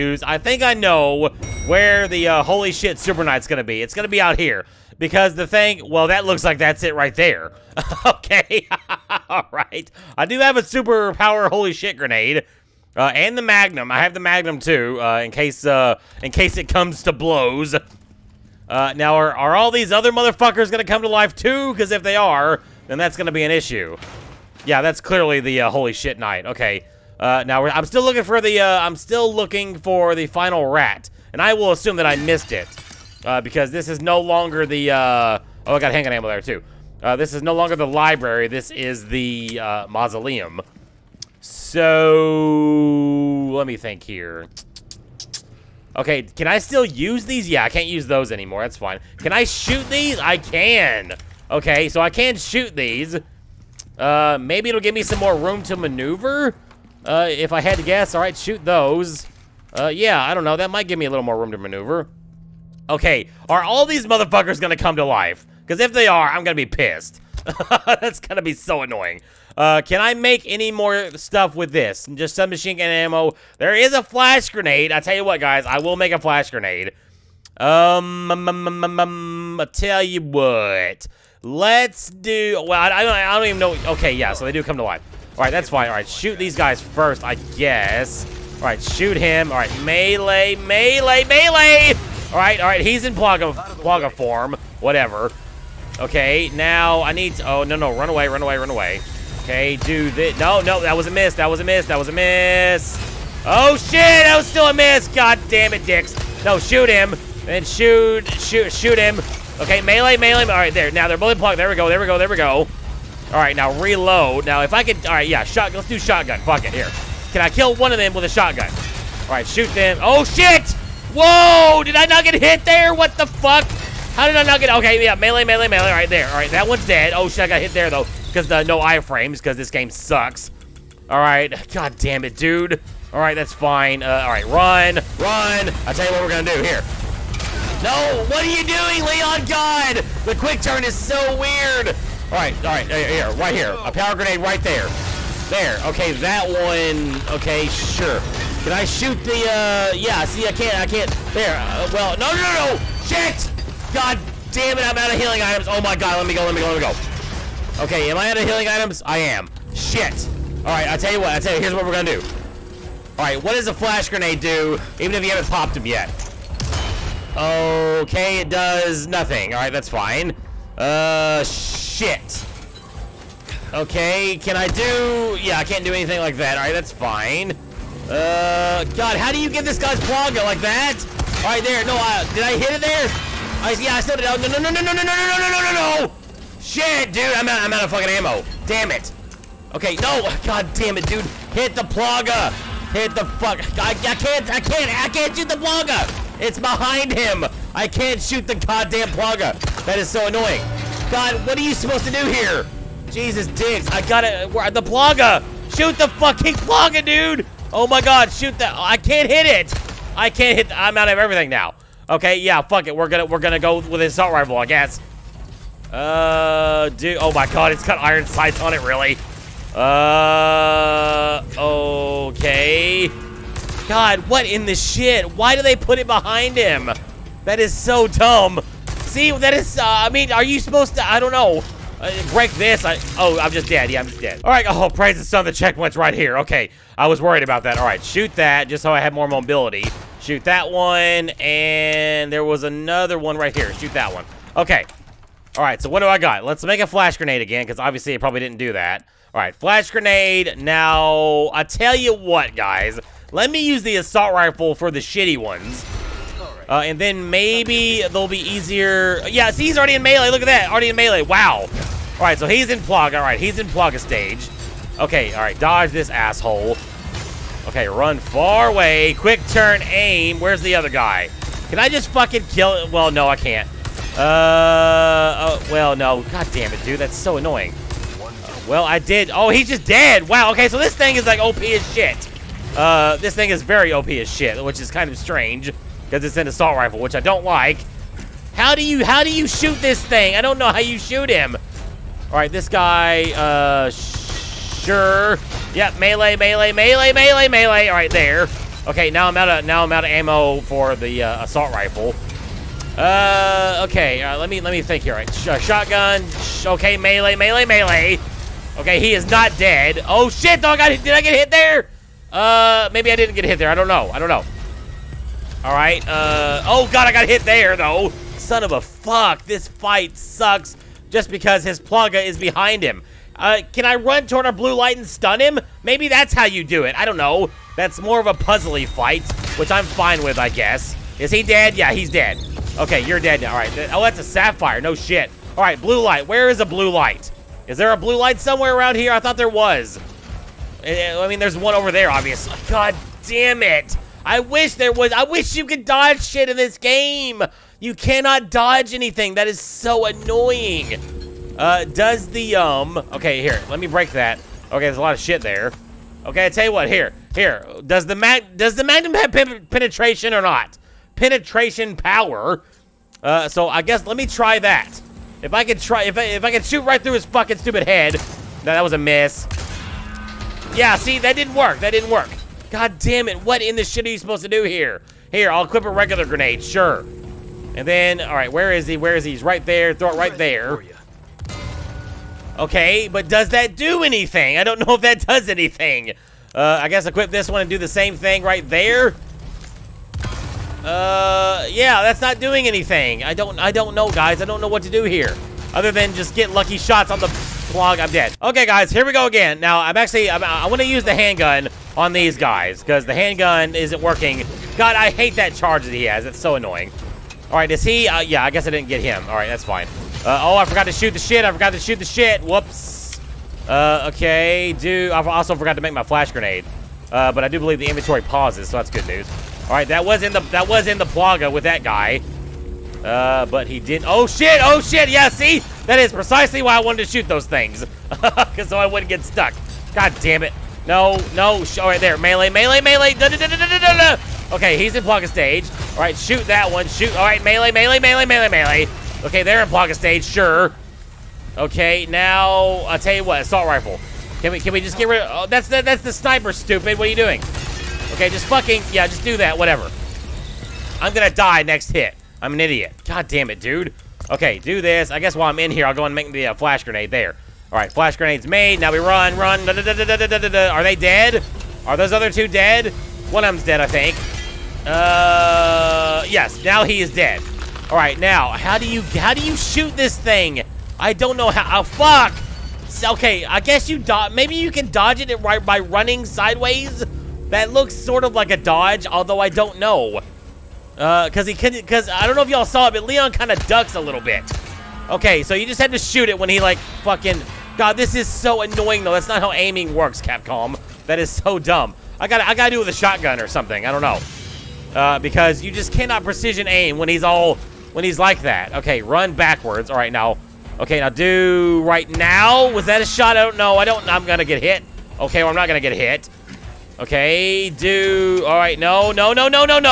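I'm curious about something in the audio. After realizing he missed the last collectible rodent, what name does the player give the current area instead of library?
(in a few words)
mausoleum.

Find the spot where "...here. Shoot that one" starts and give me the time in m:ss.
4:03.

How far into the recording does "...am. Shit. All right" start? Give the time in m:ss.
2:39.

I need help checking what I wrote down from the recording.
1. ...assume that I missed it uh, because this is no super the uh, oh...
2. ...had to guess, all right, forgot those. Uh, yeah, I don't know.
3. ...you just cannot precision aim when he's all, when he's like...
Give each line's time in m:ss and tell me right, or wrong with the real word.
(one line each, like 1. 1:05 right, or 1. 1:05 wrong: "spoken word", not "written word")
1. 0:31 wrong: "longer", not "super"
2. 0:57 wrong: "shoot", not "forgot"
3. 8:15 right.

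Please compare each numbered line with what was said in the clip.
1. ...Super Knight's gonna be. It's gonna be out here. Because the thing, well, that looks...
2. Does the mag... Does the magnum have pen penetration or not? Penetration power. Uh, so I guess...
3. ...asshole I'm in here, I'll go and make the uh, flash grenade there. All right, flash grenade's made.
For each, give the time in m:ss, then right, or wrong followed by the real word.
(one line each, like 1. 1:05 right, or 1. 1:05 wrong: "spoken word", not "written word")
1. 0:02 right
2. 5:57 right
3. 7:35 wrong: "while", not "asshole".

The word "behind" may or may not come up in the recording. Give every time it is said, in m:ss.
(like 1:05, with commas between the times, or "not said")
3:16, 3:46, 5:22.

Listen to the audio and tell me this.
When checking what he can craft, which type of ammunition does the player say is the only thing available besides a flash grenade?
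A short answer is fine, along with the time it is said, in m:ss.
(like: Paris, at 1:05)
submachine gun ammo, at 1:12.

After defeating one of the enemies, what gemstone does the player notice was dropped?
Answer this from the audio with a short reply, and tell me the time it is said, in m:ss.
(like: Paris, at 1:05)
sapphire, at 5:34.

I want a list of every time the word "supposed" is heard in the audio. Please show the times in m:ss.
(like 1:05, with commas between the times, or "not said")
3:21, 3:50, 6:14.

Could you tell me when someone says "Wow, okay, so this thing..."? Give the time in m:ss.
4:40.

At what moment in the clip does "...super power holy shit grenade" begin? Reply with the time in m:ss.
0:10.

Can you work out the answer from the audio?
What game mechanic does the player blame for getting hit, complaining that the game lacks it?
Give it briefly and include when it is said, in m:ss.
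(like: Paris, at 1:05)
iframes, at 2:08.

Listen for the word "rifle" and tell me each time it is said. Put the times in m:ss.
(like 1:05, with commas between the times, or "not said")
3:34, 4:14, 4:46, 5:01, 7:23.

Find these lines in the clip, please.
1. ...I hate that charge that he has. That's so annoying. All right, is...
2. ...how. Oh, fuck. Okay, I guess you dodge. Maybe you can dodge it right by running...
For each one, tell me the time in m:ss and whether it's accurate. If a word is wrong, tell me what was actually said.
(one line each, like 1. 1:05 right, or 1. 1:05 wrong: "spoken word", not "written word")
1. 6:44 right
2. 7:51 right.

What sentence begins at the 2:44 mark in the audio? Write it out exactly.
Even if you haven't popped them yet.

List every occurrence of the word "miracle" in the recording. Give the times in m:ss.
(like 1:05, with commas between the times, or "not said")
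not said.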